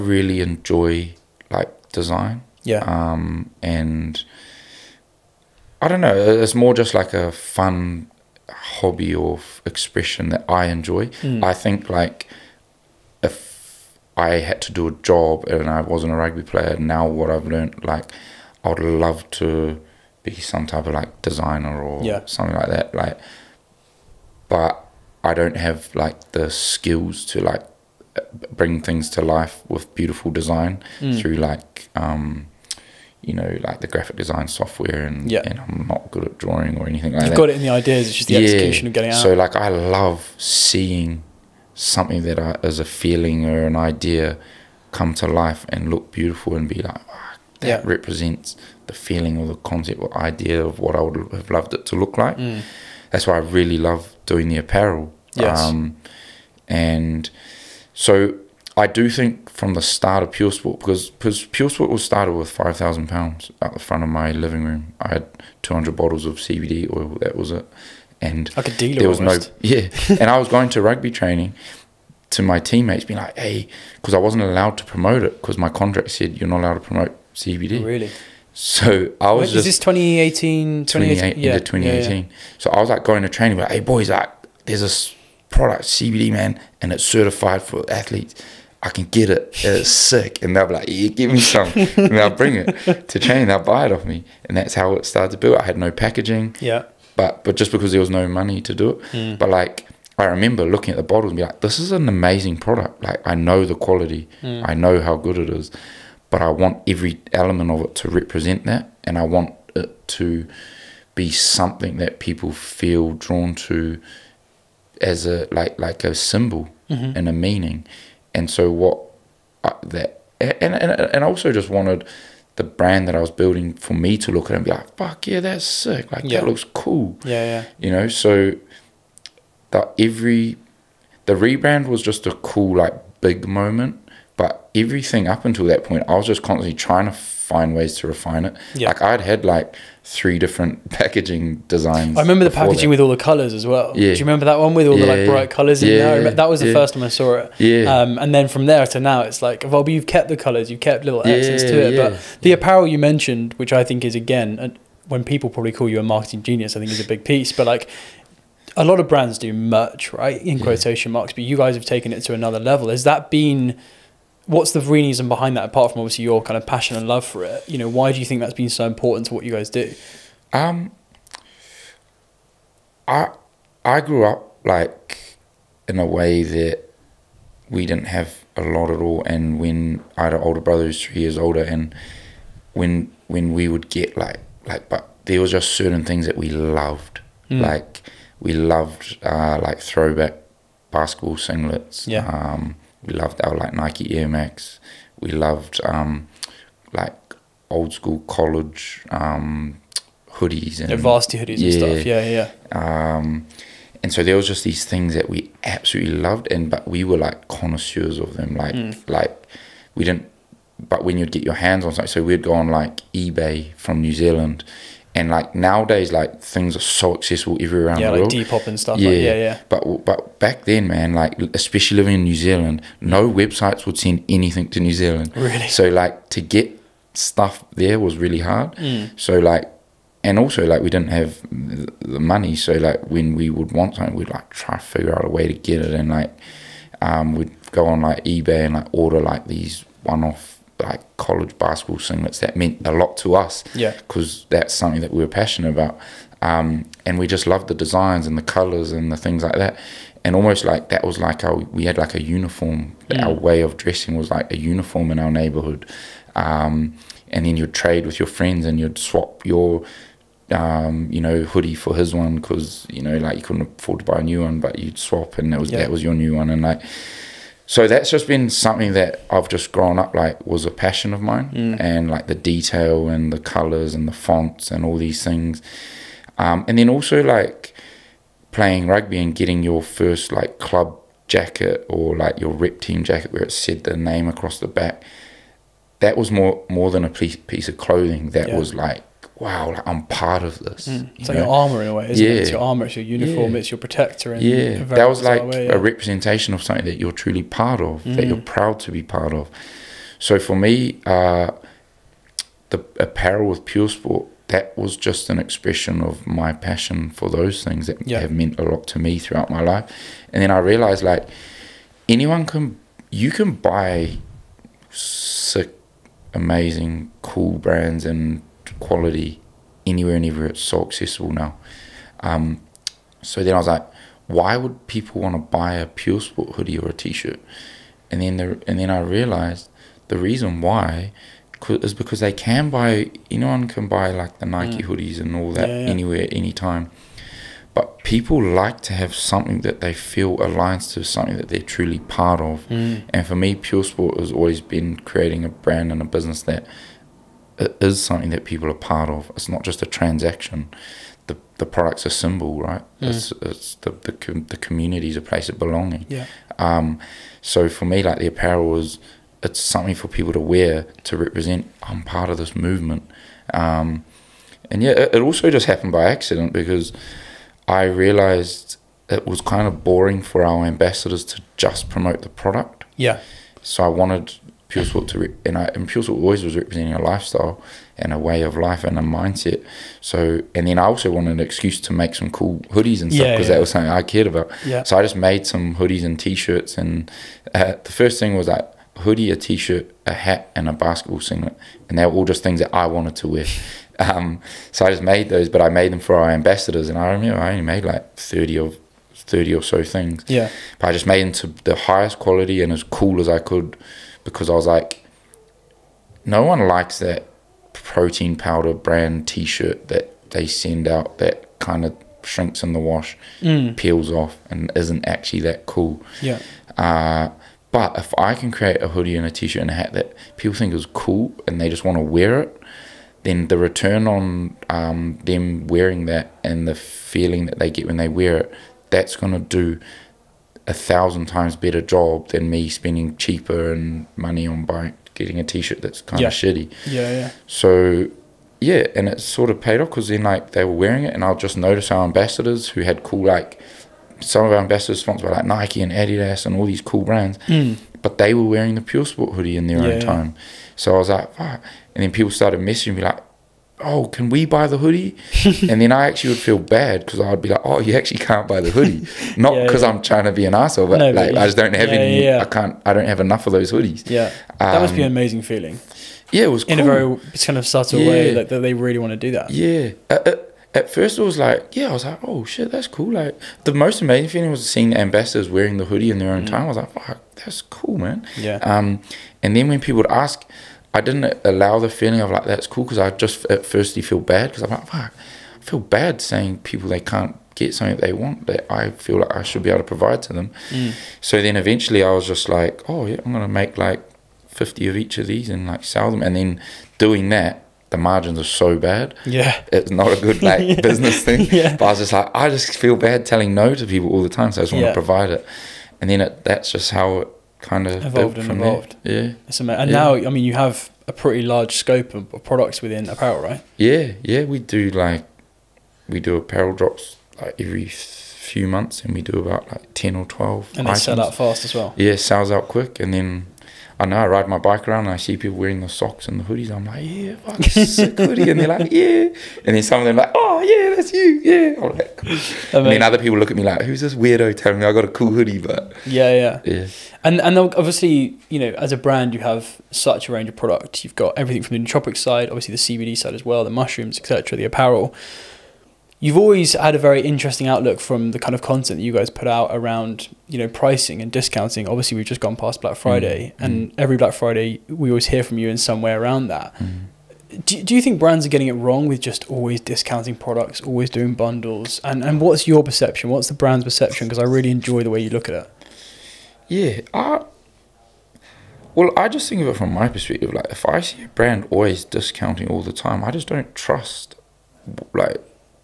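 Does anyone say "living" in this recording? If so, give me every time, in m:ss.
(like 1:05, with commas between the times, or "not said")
1:04, 3:41.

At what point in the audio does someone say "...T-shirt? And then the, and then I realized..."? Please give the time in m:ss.
5:26.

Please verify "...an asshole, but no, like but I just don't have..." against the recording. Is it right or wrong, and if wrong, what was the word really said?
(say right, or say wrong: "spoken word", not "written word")
right.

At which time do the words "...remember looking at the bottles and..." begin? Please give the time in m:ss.
1:40.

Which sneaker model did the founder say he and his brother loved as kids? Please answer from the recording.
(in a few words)
Nike Air Max.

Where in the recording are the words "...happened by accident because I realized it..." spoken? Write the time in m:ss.
6:05.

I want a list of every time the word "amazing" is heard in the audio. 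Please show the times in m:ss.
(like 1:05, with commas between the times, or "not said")
1:42, 5:16, 7:45, 7:54.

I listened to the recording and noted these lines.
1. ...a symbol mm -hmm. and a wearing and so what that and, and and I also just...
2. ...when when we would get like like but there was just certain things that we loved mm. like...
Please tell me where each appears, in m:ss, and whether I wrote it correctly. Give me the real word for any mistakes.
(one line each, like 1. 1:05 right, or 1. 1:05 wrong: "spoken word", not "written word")
1. 1:56 wrong: "meaning", not "wearing"
2. 3:02 right.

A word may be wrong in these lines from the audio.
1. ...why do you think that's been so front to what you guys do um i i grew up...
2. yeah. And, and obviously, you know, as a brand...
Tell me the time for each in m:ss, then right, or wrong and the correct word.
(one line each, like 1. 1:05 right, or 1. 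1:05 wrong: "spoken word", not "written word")
1. 2:47 wrong: "important", not "front"
2. 8:56 right.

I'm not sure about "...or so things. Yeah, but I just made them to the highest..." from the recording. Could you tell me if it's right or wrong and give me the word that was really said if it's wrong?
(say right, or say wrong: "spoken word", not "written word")
right.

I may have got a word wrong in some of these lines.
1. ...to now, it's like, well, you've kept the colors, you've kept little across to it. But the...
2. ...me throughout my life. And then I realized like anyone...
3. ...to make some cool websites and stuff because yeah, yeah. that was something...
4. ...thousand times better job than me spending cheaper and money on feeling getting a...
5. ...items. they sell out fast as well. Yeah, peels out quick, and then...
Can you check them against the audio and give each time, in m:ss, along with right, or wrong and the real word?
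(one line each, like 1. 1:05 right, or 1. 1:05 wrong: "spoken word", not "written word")
1. 2:28 wrong: "access", not "across"
2. 5:08 right
3. 6:21 wrong: "hoodies", not "websites"
4. 7:10 wrong: "buying", not "feeling"
5. 8:40 wrong: "sells", not "peels".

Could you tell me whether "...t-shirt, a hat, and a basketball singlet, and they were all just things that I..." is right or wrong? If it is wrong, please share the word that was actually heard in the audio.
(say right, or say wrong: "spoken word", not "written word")
right.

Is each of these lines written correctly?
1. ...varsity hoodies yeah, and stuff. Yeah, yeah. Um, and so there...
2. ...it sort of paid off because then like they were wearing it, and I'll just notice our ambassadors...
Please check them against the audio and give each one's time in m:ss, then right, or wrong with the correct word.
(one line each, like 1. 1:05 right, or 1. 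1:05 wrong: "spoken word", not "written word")
1. 3:20 right
2. 7:19 right.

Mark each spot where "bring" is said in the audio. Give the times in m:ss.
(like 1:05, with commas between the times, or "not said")
0:28, 1:32.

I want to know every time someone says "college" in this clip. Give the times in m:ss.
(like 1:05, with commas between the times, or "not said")
3:18, 4:01.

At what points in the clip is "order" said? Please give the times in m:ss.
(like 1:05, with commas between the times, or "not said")
3:58.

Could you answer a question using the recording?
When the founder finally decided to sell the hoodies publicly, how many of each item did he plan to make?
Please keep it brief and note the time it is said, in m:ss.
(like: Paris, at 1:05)
50, at 8:14.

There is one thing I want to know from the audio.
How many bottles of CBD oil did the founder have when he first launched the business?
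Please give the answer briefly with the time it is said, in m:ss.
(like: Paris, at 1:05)
200, at 1:05.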